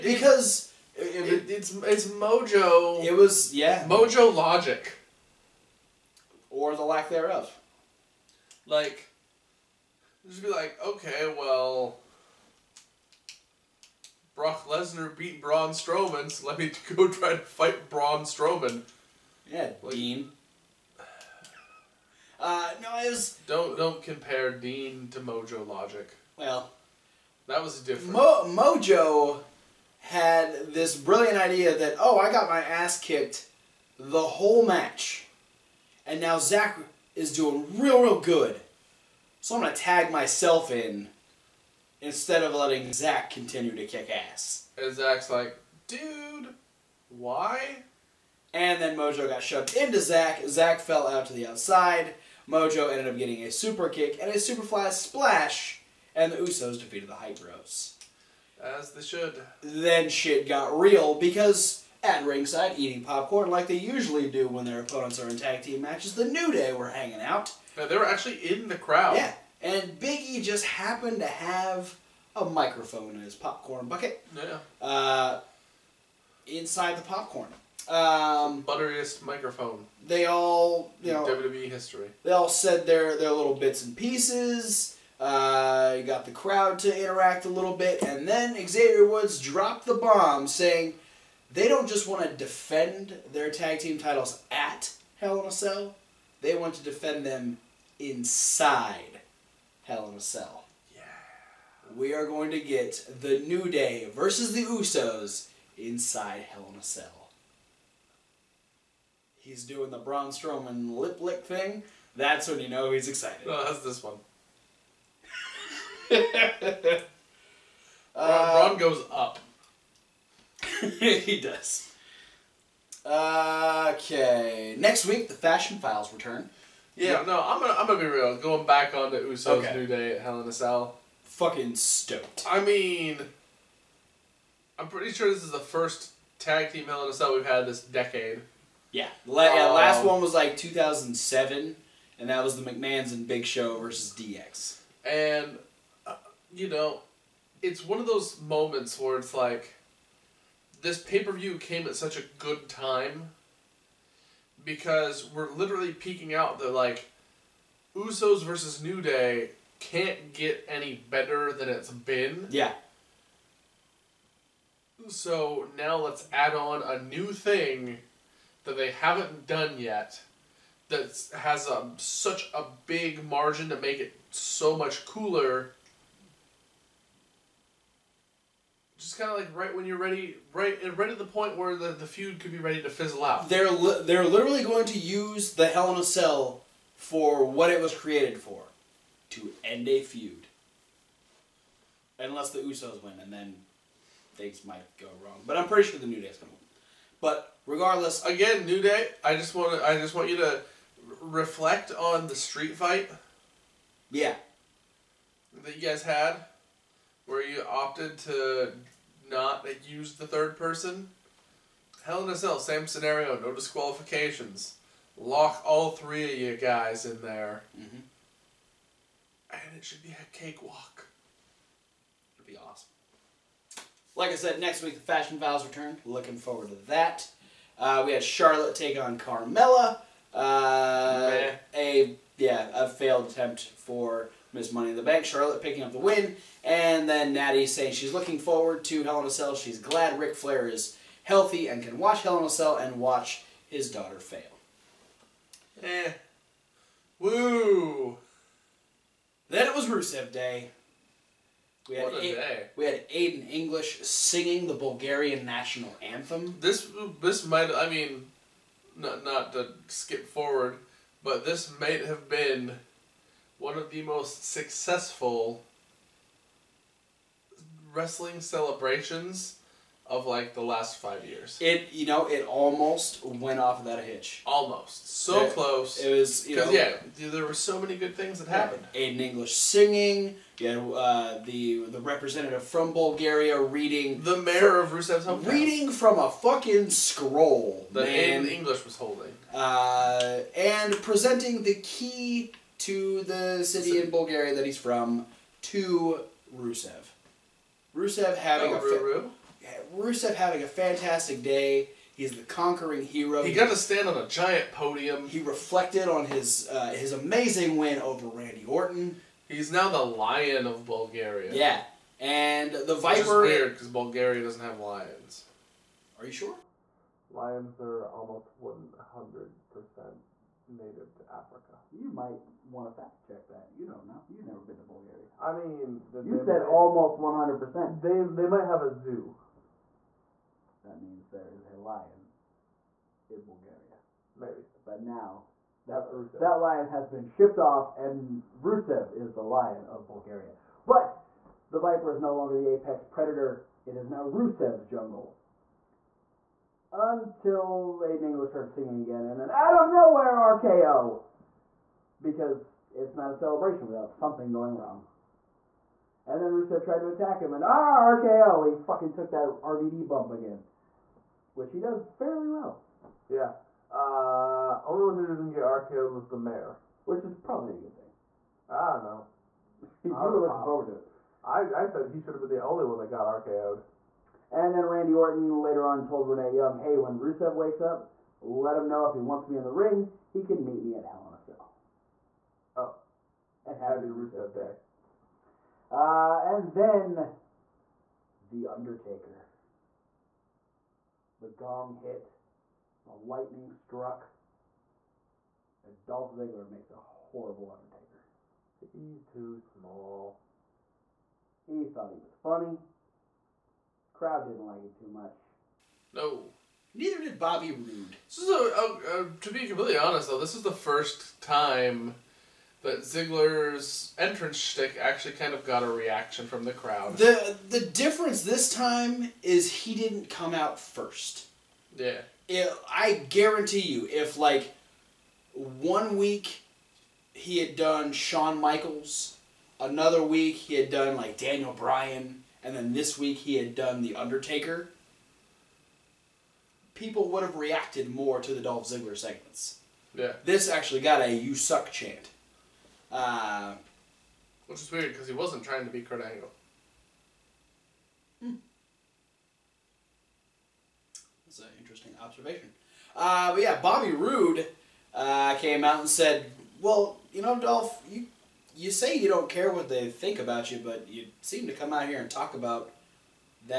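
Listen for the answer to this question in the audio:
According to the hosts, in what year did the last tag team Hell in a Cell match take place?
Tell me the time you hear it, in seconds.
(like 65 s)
140 s.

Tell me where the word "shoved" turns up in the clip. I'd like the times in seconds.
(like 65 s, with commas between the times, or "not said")
49 s.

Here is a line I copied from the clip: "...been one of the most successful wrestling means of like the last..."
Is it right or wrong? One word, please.
wrong.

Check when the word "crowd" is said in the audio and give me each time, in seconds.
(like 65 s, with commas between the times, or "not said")
68 s, 86 s, 404 s, 416 s.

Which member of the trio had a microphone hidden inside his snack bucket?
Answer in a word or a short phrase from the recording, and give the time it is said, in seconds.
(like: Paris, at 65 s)
Big E, at 69 s.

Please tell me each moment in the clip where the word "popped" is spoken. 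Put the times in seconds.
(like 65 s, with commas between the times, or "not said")
370 s.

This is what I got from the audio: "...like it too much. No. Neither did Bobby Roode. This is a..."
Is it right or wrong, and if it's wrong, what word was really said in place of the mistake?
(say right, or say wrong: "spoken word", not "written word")
right.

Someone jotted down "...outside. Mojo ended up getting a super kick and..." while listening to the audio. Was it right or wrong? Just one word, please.
right.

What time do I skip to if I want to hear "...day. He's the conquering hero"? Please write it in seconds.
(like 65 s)
301 s.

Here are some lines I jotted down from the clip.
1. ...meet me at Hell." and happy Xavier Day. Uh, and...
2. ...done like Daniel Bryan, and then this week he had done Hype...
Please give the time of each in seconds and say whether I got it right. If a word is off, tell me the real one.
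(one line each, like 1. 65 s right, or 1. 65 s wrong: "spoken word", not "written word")
1. 380 s wrong: "Rusev", not "Xavier"
2. 430 s wrong: "The", not "Hype".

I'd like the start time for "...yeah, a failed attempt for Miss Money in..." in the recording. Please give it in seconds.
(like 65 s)
232 s.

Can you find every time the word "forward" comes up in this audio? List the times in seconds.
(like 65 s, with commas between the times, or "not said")
226 s, 238 s, 260 s, 370 s.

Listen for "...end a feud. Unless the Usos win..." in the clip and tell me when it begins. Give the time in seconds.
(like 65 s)
189 s.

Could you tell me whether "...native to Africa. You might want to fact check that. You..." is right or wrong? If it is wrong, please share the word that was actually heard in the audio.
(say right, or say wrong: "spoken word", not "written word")
right.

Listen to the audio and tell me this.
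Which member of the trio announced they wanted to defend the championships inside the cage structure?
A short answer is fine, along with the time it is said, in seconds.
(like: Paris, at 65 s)
Xavier Woods, at 88 s.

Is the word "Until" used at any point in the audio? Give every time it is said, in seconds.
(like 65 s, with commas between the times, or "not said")
346 s.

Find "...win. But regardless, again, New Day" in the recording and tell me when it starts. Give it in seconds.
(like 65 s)
196 s.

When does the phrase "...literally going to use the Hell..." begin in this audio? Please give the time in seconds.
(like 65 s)
184 s.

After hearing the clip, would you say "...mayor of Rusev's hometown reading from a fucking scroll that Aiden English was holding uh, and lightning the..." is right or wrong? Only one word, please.
wrong.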